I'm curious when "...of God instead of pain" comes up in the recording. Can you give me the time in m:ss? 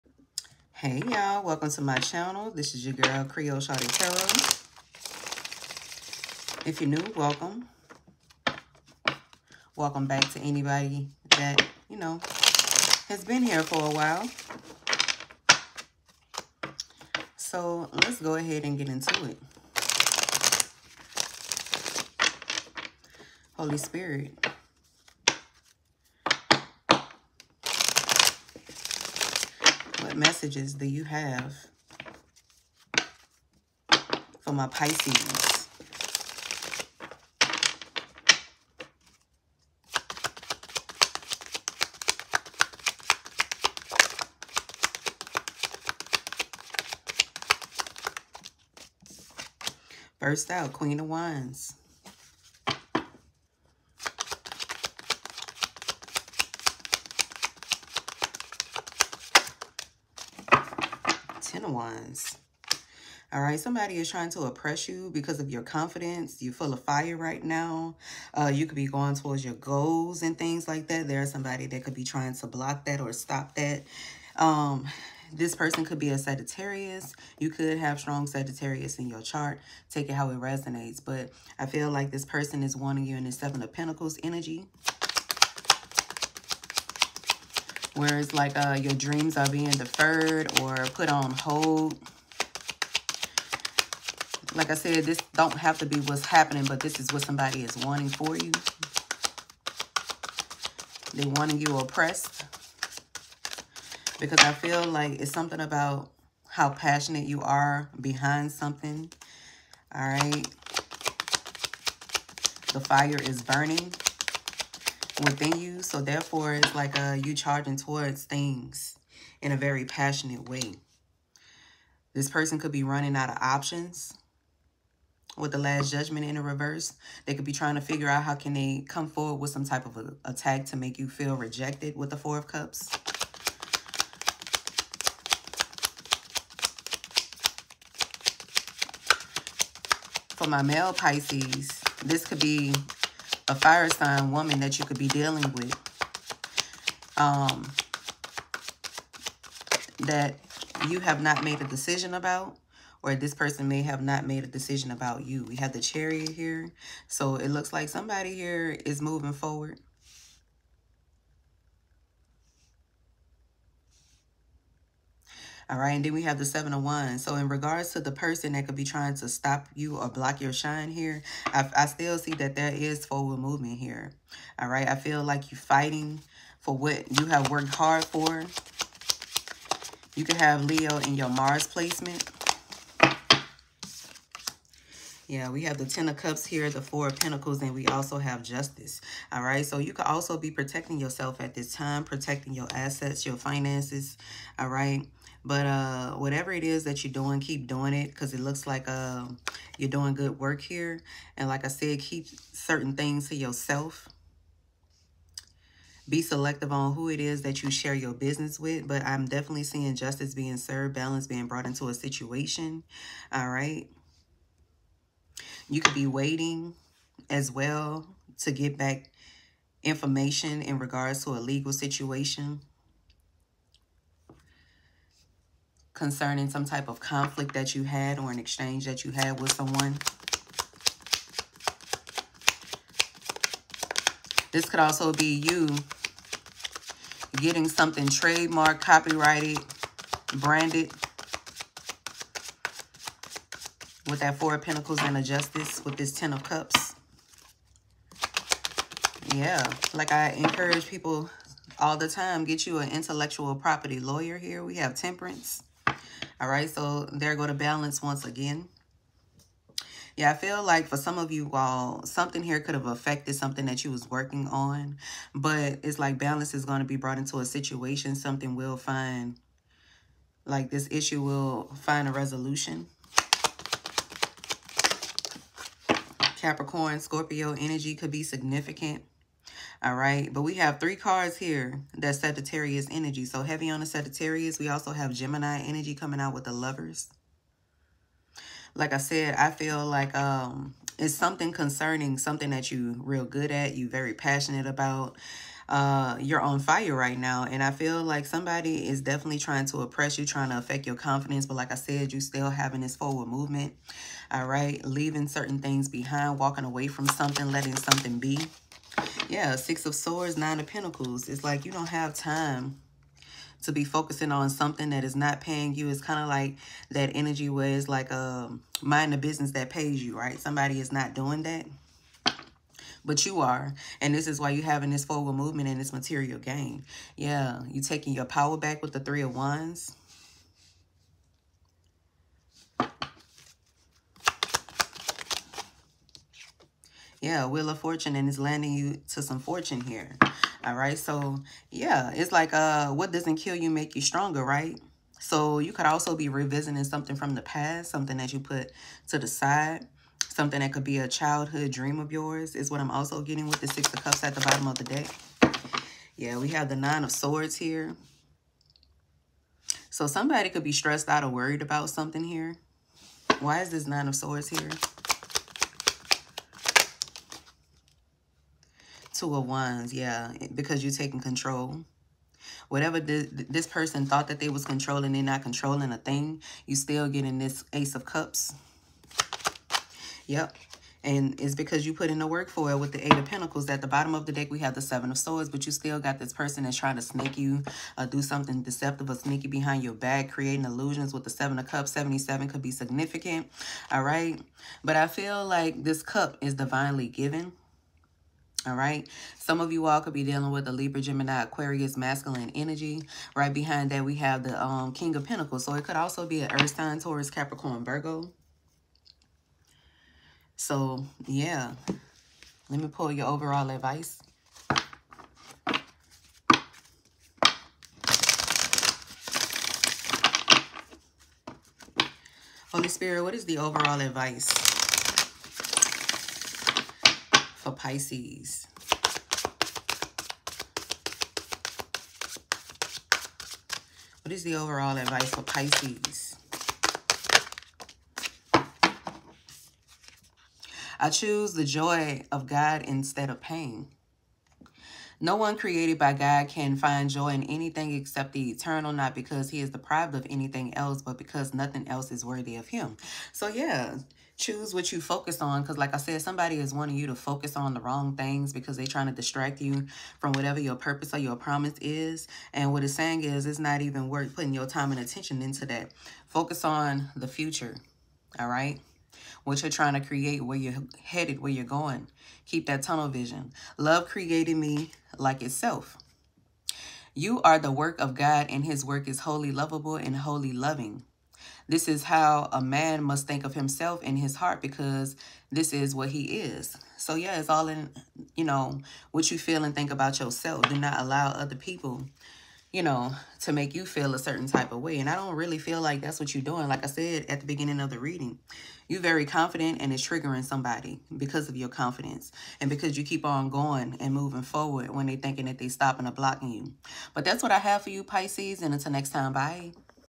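7:22.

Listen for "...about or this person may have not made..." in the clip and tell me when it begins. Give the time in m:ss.
2:32.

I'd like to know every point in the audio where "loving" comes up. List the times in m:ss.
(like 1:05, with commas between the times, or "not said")
8:00.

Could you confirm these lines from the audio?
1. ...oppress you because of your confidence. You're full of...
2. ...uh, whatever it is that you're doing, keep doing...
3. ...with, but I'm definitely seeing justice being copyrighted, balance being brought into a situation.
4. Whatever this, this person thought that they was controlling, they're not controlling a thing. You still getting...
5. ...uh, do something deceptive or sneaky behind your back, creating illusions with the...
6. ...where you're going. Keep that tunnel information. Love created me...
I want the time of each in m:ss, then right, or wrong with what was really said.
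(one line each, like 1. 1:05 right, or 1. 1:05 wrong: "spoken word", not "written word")
1. 1:04 right
2. 3:15 right
3. 3:28 wrong: "served", not "copyrighted"
4. 6:12 right
5. 6:27 right
6. 7:51 wrong: "vision", not "information".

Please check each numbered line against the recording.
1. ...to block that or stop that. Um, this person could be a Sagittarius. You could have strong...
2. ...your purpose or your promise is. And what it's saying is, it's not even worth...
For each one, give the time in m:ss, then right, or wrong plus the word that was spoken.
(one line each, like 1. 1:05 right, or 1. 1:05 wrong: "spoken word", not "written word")
1. 1:12 right
2. 7:40 right.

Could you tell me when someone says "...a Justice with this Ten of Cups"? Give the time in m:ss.
4:05.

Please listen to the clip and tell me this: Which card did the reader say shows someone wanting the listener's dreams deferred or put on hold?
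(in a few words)
Seven of Pentacles.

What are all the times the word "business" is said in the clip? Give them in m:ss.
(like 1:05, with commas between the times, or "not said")
3:28, 5:19.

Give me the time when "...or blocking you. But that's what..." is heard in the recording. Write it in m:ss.
8:26.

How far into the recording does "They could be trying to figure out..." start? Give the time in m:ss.
2:07.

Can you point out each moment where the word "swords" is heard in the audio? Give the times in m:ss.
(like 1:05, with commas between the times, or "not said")
5:09, 5:57, 6:04, 6:25.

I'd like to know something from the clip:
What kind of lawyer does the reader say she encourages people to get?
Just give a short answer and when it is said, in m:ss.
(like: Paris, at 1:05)
intellectual property lawyer, at 4:12.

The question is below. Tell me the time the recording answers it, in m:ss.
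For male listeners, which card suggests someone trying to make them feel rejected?
2:12.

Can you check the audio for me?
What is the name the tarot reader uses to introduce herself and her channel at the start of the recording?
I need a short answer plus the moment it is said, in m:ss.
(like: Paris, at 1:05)
Creole Shawty Tarot, at 0:03.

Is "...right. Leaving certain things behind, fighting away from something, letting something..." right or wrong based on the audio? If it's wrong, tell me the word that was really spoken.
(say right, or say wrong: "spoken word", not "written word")
wrong: "walking", not "fighting".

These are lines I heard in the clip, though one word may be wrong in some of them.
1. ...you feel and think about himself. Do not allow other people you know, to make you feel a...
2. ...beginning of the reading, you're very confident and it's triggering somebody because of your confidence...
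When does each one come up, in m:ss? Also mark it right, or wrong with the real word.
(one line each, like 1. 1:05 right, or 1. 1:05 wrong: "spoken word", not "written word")
1. 8:09 wrong: "yourself", not "himself"
2. 8:17 right.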